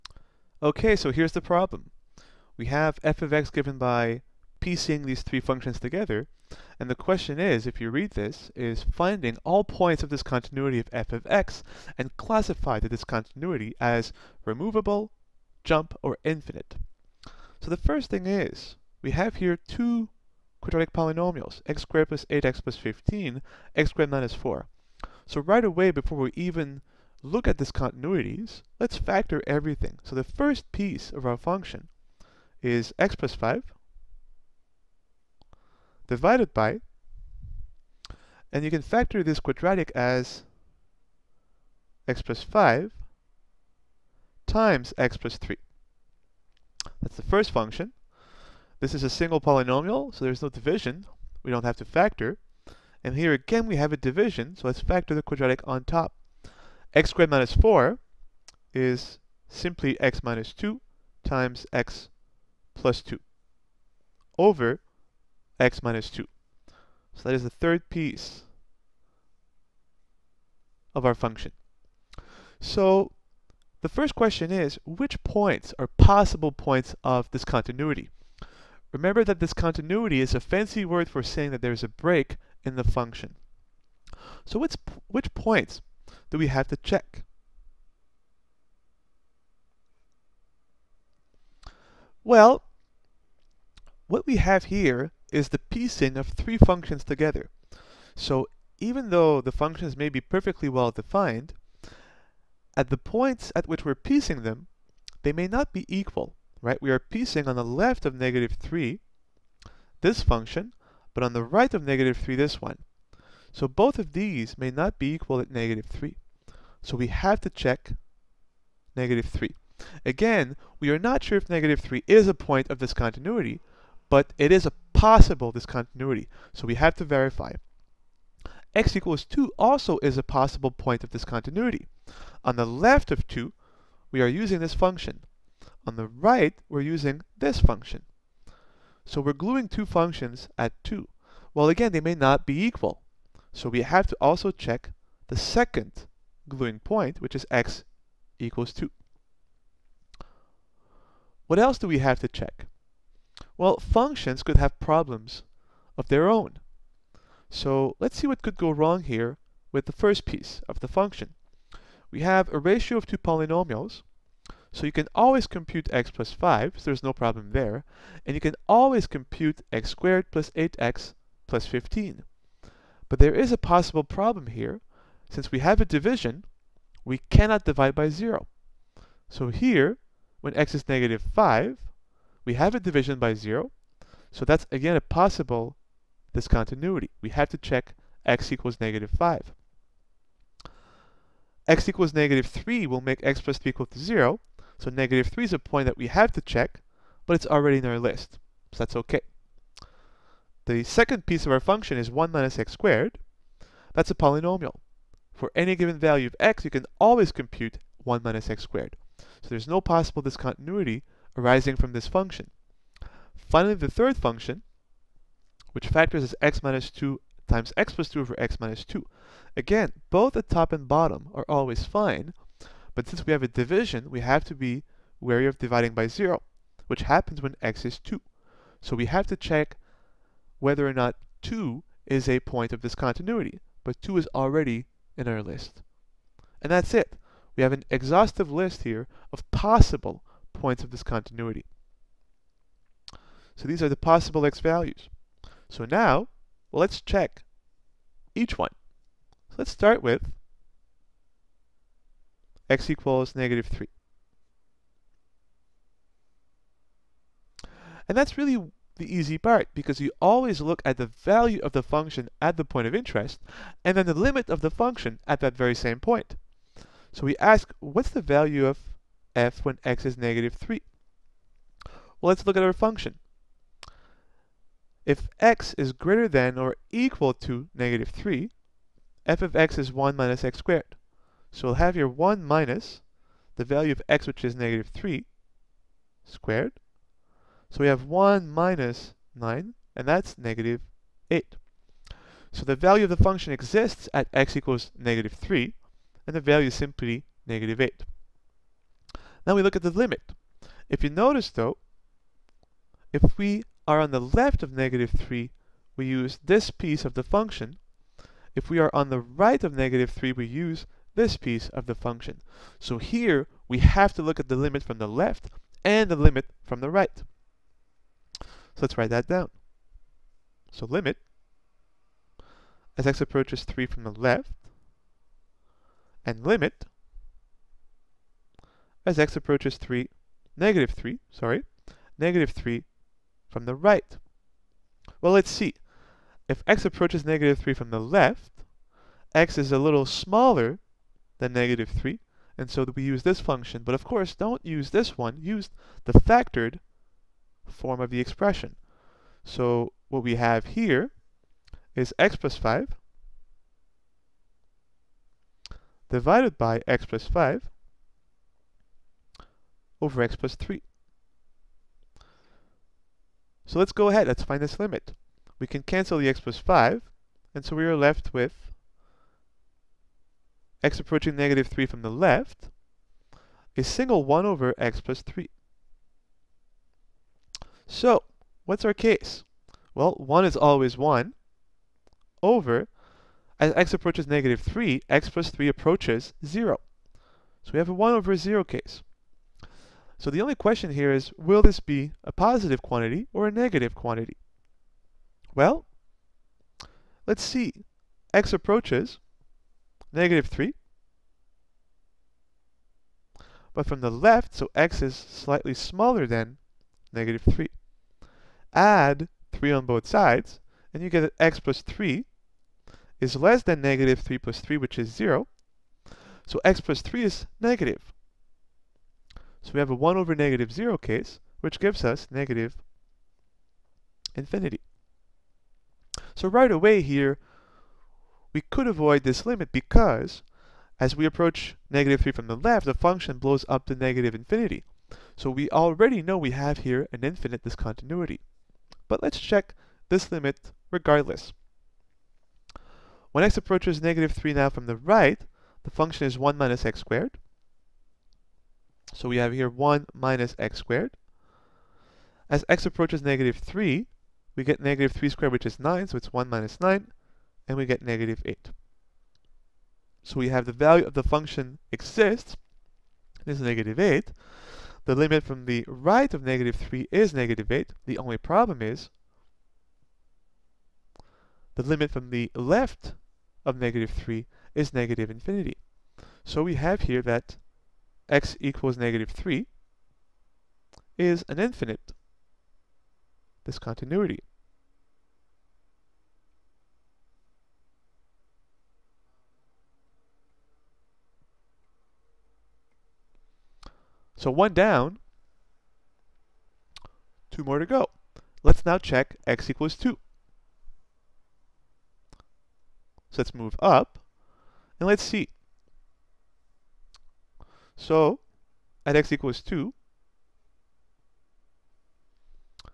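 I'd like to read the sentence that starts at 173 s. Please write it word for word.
But there is a possible problem here.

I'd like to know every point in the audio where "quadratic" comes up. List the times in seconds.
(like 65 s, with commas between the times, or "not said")
20 s, 39 s, 55 s.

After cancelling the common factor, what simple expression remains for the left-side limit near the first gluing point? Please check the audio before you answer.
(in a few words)
1 over x plus 3.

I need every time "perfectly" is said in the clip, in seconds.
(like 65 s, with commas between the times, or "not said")
100 s.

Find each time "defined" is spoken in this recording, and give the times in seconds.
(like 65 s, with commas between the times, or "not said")
100 s.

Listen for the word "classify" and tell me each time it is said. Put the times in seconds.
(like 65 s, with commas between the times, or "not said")
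12 s.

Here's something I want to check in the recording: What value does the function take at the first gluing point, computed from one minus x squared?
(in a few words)
-8.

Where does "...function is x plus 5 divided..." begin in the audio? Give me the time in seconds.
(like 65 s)
31 s.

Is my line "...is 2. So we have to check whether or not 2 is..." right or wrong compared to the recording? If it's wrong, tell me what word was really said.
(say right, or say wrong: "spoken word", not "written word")
right.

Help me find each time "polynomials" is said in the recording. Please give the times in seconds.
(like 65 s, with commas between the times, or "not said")
20 s, 49 s, 163 s, 204 s.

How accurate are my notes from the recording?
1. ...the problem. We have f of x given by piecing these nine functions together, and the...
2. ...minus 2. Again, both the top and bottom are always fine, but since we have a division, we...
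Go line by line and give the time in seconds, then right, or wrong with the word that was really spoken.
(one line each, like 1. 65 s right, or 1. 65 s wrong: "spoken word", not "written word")
1. 1 s wrong: "three", not "nine"
2. 218 s right.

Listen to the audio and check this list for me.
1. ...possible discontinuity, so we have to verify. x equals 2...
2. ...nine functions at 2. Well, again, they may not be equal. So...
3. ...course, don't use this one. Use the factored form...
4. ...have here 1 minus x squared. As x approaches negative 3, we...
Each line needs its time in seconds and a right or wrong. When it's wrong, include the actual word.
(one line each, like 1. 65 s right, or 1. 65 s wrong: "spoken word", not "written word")
1. 124 s right
2. 139 s wrong: "two", not "nine"
3. 344 s right
4. 449 s right.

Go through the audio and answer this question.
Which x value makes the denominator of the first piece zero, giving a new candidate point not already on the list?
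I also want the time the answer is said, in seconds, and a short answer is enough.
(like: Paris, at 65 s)
-5, at 180 s.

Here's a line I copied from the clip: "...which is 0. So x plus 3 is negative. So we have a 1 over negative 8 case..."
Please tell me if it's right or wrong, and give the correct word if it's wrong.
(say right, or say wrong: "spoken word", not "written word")
wrong: "0", not "8".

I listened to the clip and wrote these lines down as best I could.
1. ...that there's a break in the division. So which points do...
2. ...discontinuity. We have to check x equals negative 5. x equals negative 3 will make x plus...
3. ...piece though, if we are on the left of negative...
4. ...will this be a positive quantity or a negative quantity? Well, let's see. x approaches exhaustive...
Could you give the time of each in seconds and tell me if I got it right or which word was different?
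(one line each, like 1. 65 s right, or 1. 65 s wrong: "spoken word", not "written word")
1. 81 s wrong: "function", not "division"
2. 186 s right
3. 301 s wrong: "notice", not "piece"
4. 391 s wrong: "negative", not "exhaustive".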